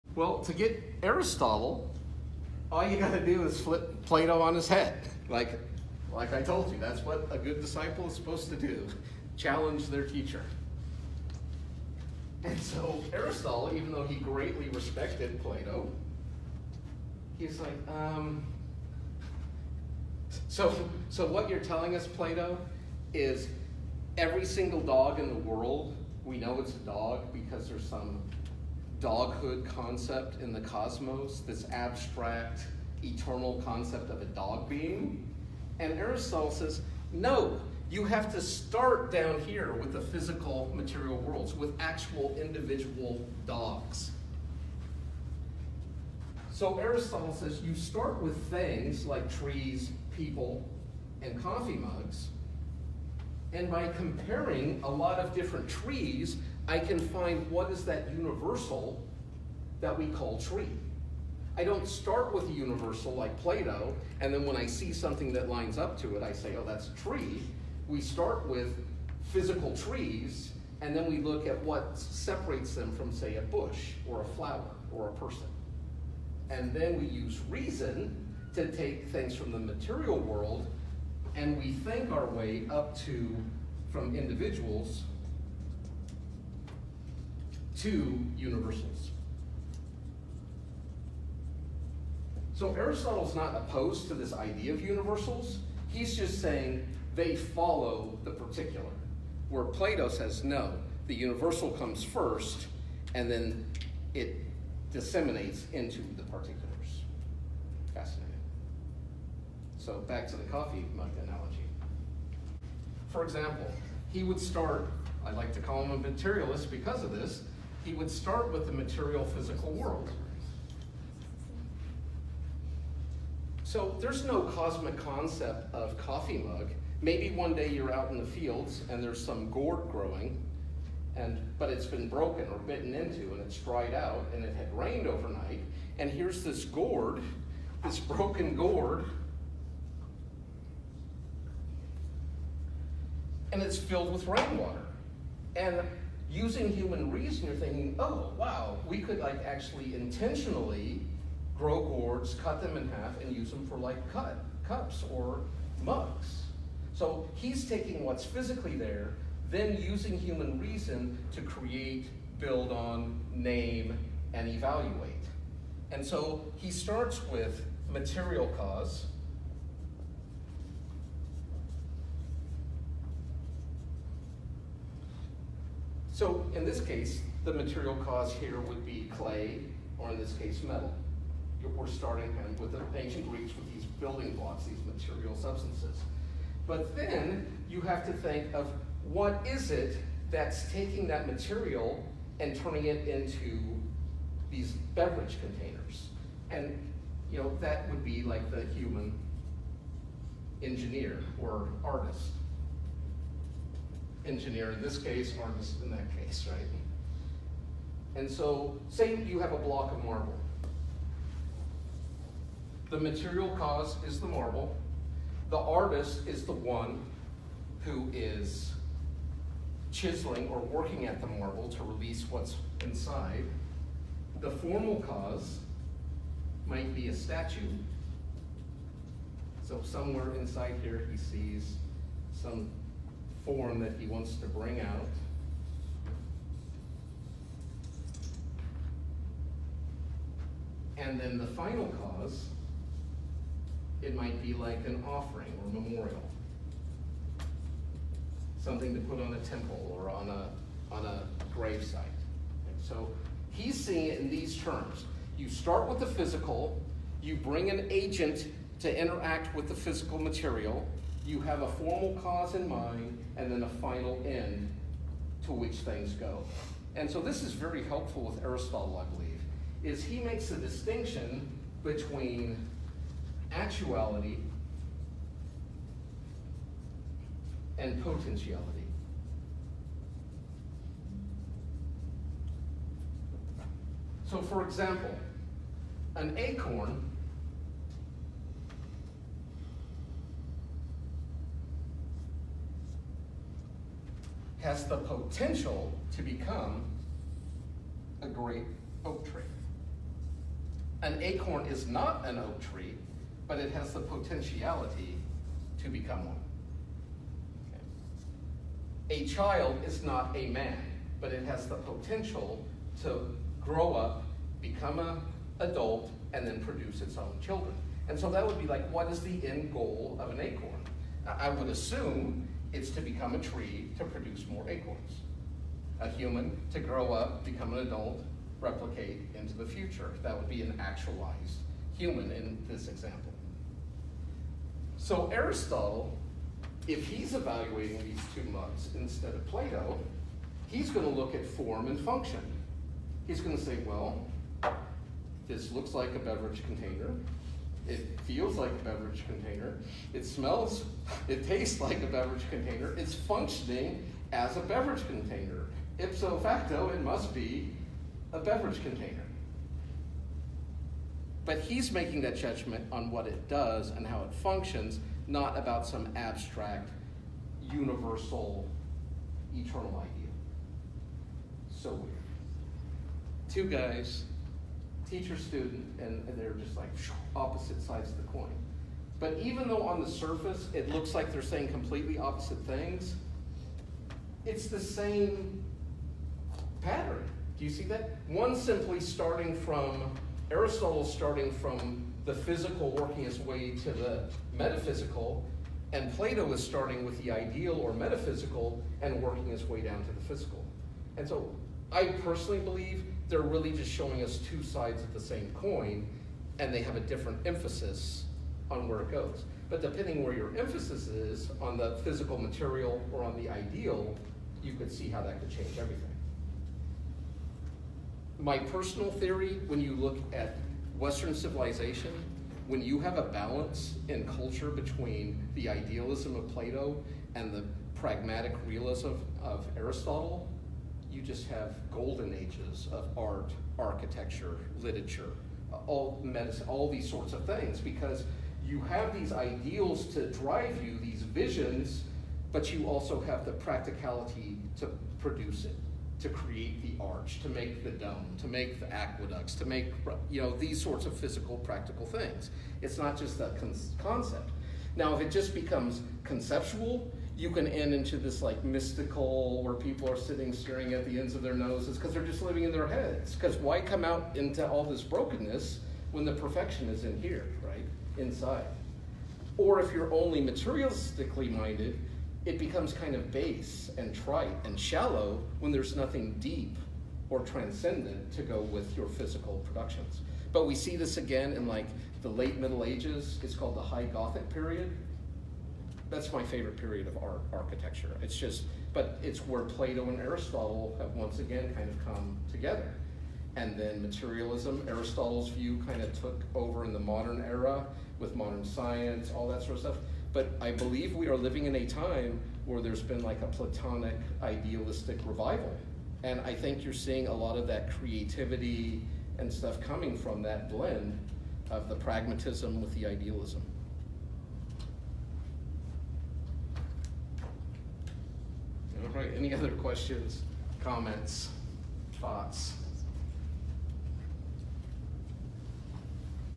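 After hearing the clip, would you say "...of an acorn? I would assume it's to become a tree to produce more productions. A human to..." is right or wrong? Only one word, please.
wrong.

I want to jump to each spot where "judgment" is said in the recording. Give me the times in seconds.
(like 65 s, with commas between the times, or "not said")
362 s.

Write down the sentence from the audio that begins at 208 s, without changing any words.
And so, say you have a block of marble.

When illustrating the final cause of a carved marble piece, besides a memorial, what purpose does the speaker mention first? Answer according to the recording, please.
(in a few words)
an offering.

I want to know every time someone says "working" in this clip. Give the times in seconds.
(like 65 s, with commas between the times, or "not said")
220 s, 392 s, 399 s.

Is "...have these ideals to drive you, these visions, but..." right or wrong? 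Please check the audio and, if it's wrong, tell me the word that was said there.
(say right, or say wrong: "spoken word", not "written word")
right.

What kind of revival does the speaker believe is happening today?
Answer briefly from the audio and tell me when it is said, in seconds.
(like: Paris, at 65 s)
platonic idealistic revival, at 503 s.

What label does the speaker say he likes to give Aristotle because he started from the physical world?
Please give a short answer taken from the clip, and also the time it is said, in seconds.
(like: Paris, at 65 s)
materialist, at 115 s.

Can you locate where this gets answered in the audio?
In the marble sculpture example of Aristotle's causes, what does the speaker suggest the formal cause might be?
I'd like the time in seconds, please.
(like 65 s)
227 s.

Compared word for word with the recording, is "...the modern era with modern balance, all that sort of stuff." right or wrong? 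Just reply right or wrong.
wrong.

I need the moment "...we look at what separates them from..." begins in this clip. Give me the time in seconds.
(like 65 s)
71 s.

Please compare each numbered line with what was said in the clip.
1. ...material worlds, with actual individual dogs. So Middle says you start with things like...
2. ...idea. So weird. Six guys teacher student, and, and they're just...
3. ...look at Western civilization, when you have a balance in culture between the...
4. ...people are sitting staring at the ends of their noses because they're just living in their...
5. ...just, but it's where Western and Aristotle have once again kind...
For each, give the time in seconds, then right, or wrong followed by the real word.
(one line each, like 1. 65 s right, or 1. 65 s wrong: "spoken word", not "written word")
1. 40 s wrong: "Aristotle", not "Middle"
2. 369 s wrong: "Two", not "Six"
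3. 419 s right
4. 459 s right
5. 488 s wrong: "Plato", not "Western".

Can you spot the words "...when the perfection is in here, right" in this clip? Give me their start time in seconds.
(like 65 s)
466 s.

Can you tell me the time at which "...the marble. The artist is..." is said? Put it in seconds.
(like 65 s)
214 s.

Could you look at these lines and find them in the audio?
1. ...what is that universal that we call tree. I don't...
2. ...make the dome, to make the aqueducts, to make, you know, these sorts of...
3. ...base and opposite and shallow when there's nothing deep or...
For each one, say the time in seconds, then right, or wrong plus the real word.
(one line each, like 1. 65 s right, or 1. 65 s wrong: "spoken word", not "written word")
1. 57 s right
2. 447 s right
3. 473 s wrong: "trite", not "opposite".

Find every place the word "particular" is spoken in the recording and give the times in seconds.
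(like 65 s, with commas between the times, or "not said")
98 s, 106 s.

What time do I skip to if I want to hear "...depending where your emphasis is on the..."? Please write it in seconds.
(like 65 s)
409 s.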